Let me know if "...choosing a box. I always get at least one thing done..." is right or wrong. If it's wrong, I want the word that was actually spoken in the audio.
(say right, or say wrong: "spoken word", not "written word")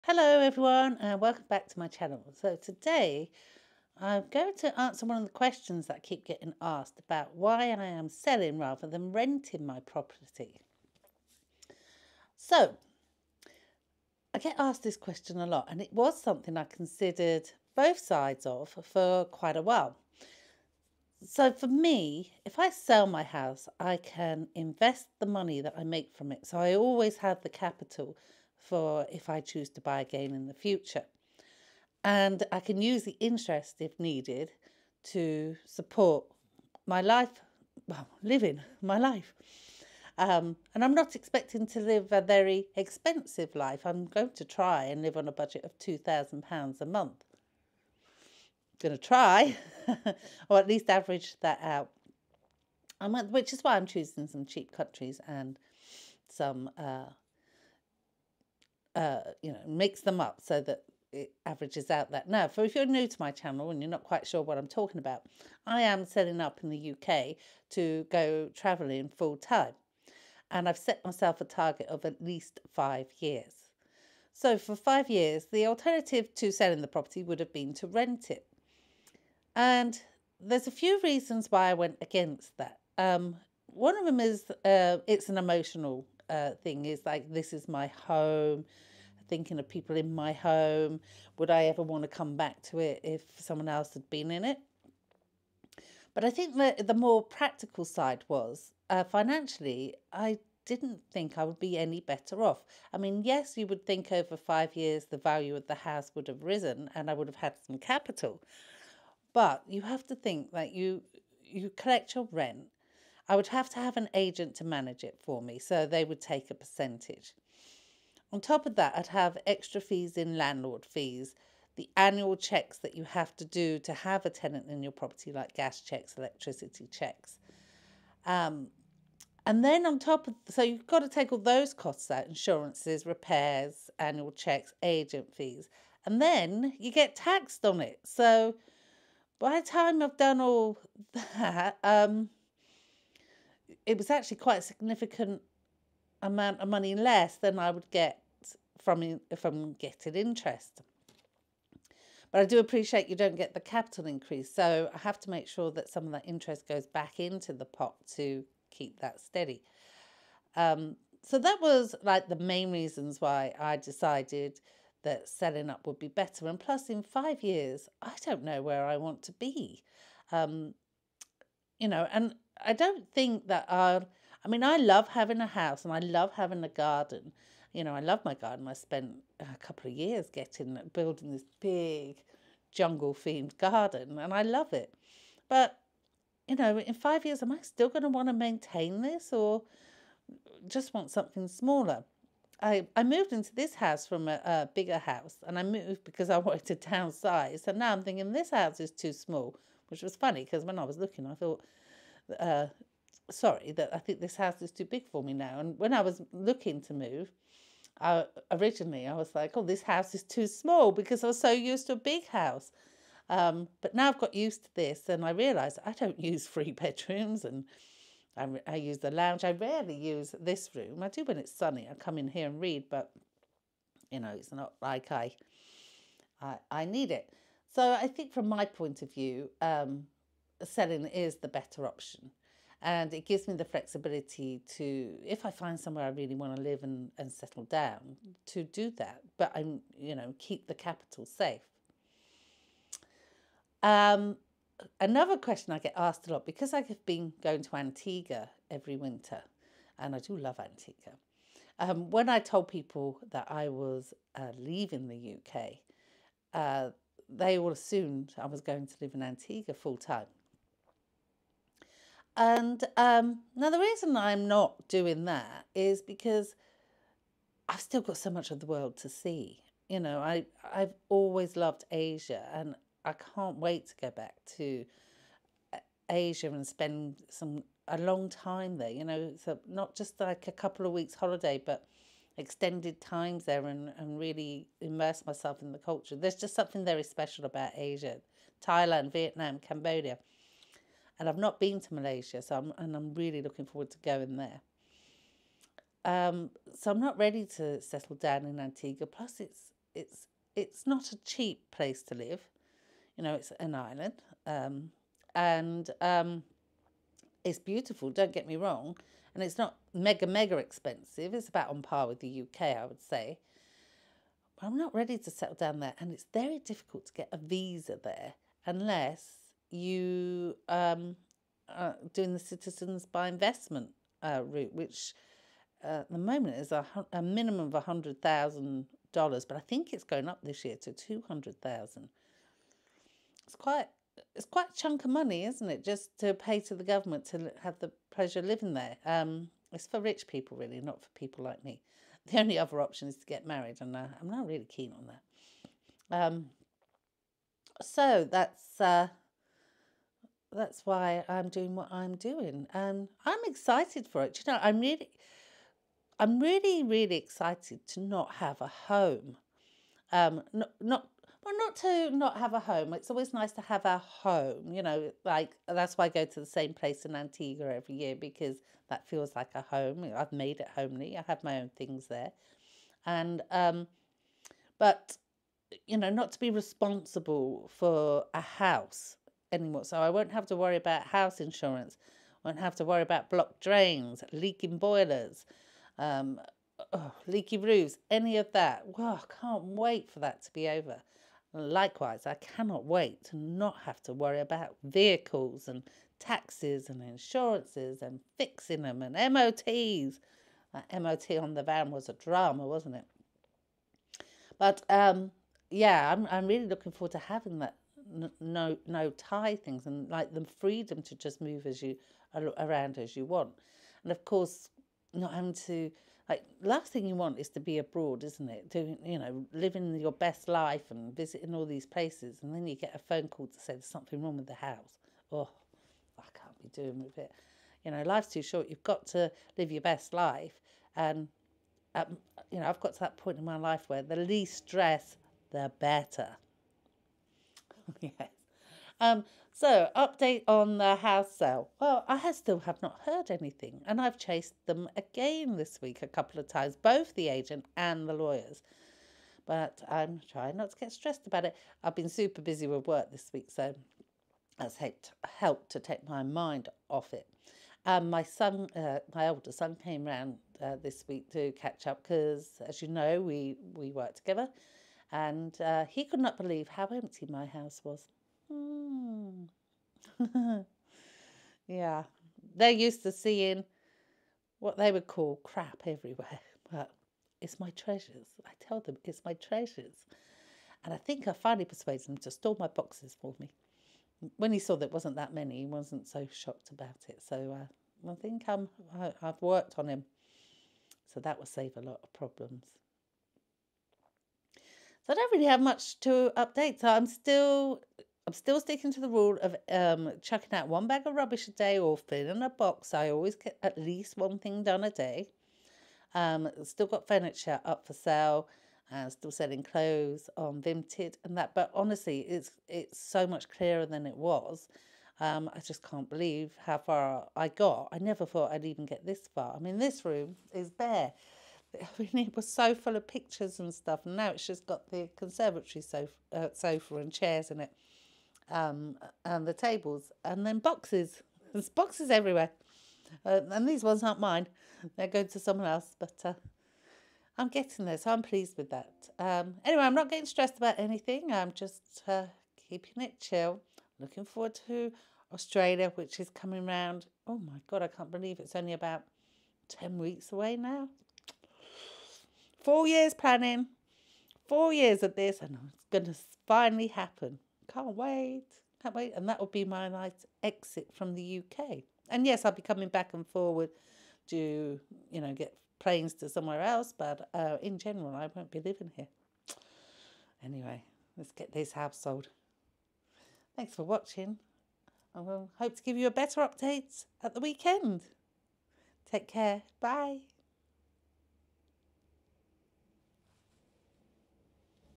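wrong: "filling", not "choosing".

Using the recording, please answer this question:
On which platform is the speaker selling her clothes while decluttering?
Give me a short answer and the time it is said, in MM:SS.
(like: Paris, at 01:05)
Vinted, at 08:30.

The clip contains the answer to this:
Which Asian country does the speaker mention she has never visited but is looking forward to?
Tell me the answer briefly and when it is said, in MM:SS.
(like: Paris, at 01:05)
Malaysia, at 04:51.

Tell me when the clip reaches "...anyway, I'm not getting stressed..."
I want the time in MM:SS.
08:59.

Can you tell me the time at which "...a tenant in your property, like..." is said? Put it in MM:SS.
02:04.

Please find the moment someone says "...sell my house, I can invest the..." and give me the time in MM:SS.
00:22.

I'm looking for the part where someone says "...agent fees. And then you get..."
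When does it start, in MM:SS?
02:14.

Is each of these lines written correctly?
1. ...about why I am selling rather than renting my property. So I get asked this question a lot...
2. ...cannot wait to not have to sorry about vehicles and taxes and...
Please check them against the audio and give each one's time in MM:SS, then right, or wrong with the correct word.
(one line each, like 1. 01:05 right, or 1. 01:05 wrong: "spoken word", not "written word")
1. 00:06 right
2. 06:32 wrong: "worry", not "sorry".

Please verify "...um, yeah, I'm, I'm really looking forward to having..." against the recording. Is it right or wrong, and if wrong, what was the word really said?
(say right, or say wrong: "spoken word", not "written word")
right.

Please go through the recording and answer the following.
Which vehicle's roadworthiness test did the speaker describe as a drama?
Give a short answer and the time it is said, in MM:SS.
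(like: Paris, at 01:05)
The van, at 06:41.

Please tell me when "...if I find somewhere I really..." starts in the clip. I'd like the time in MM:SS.
03:55.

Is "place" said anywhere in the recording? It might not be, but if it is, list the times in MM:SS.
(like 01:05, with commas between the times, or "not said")
05:01, 06:06, 07:01.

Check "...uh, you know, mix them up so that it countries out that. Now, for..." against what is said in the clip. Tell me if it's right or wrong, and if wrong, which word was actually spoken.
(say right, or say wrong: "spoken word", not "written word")
wrong: "averages", not "countries".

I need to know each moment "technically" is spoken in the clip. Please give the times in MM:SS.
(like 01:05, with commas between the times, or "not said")
not said.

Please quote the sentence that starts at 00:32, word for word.
And I can use the interest if needed to support my life, well, living my life.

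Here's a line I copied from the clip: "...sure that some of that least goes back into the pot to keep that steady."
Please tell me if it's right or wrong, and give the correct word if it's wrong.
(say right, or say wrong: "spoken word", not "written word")
wrong: "interest", not "least".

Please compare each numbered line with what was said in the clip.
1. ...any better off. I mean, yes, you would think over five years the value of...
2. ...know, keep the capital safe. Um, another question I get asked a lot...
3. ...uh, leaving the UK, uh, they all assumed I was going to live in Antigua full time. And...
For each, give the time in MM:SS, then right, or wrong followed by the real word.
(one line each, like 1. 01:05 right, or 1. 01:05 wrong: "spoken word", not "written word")
1. 01:41 right
2. 04:00 right
3. 04:14 right.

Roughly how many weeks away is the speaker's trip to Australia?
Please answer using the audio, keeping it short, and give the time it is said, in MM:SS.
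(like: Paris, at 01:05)
10 weeks, at 09:09.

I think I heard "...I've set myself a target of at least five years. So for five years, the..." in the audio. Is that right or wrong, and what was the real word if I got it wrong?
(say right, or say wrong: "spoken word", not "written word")
right.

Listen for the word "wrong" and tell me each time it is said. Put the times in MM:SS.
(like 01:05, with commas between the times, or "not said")
05:08, 07:04.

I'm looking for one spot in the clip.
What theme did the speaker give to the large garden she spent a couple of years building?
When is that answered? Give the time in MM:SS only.
03:02.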